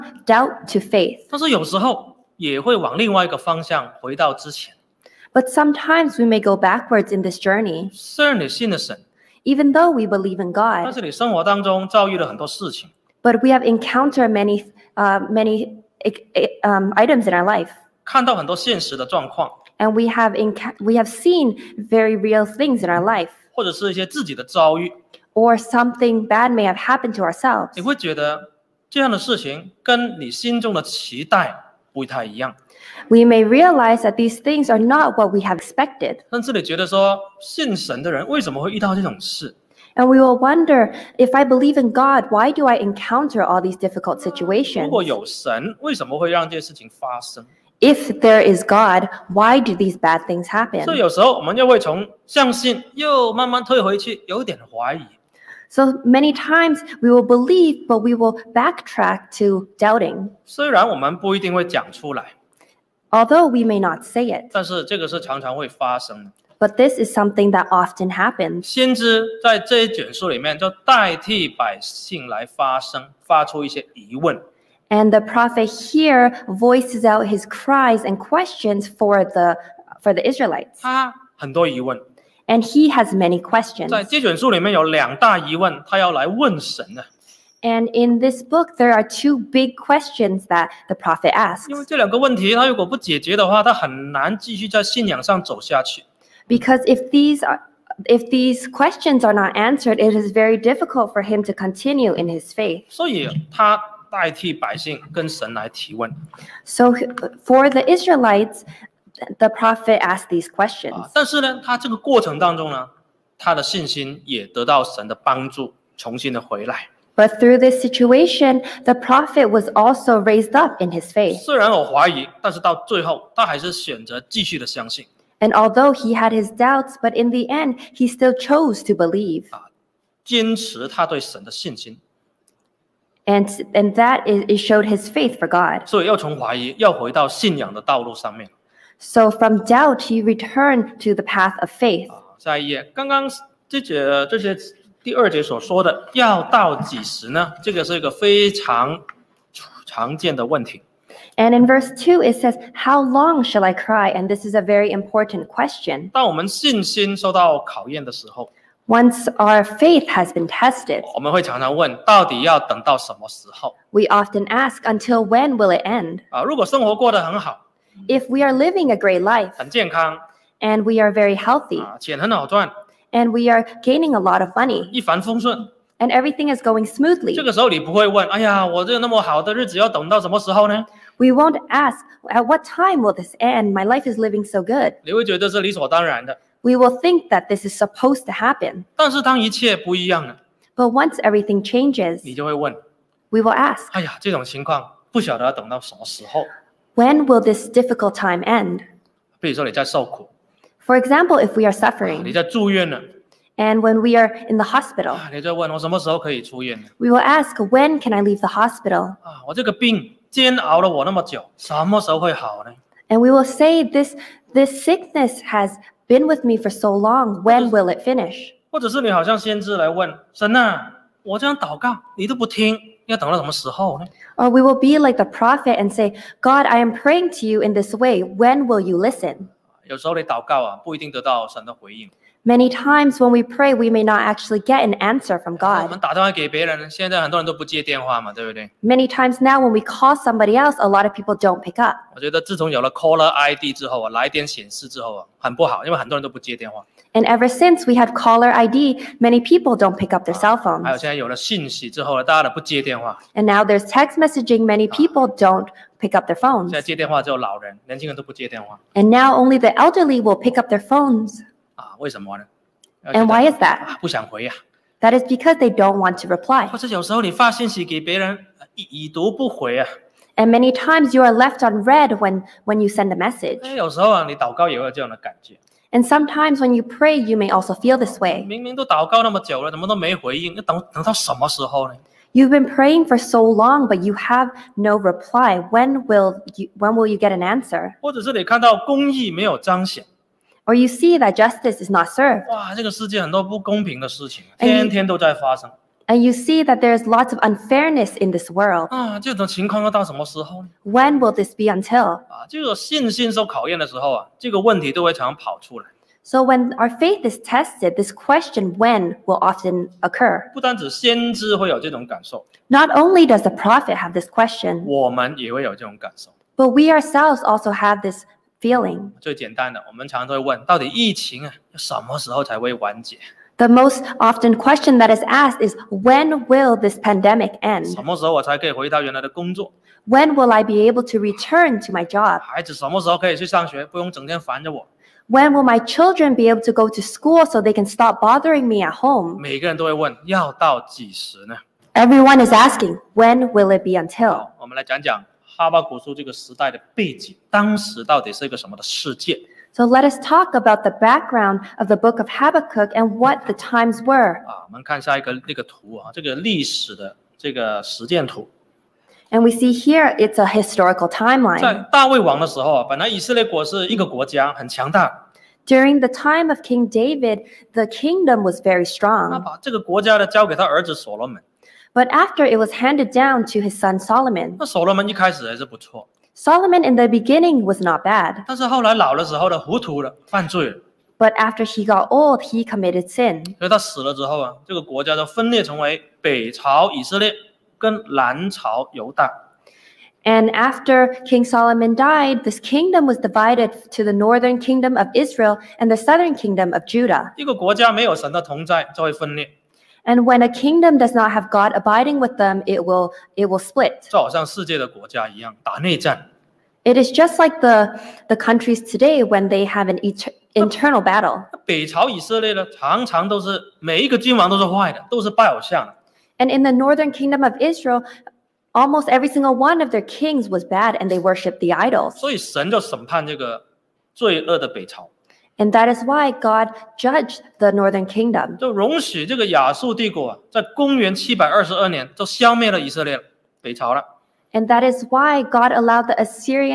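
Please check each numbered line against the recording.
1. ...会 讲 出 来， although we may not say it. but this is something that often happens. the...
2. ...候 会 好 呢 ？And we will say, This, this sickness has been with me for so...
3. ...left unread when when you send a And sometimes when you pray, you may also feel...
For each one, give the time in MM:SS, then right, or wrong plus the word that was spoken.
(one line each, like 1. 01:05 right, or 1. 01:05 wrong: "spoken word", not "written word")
1. 01:01 right
2. 03:32 right
3. 04:31 right.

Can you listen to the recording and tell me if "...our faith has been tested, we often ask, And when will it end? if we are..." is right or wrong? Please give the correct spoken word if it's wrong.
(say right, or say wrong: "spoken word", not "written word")
wrong: "Until", not "And".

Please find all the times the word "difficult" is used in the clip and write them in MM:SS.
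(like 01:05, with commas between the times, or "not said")
00:43, 01:40, 03:17.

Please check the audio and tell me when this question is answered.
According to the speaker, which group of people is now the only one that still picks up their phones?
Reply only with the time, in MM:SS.
04:19.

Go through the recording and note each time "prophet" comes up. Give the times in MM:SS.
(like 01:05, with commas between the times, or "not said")
01:15, 01:30, 01:49, 01:58, 03:45, 05:13.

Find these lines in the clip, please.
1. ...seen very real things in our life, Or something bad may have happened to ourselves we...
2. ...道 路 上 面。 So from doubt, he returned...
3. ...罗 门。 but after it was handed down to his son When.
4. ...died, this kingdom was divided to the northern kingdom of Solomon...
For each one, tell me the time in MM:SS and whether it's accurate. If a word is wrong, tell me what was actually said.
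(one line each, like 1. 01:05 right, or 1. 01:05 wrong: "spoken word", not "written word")
1. 00:21 right
2. 02:17 right
3. 06:11 wrong: "Solomon", not "When"
4. 06:31 wrong: "Israel", not "Solomon".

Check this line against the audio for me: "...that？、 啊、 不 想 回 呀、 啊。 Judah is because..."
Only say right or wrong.
wrong.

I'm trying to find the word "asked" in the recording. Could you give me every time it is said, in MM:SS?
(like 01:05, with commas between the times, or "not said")
01:50, 05:25.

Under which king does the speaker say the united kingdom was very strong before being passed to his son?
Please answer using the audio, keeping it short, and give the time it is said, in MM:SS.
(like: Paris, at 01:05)
King David, at 06:06.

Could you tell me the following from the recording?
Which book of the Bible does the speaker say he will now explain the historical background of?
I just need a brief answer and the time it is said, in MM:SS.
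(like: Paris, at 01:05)
Habakkuk, at 05:52.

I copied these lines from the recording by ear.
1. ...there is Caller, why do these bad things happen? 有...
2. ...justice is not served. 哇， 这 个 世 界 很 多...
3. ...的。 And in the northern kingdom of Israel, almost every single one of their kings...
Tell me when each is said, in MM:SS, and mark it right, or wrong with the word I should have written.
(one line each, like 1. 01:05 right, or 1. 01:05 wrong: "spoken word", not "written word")
1. 00:48 wrong: "God", not "Caller"
2. 04:51 right
3. 06:55 right.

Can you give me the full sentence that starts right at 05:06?
So when our faith is tested, this question when will often occur.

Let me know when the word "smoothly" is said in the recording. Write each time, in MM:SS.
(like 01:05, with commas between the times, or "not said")
02:56.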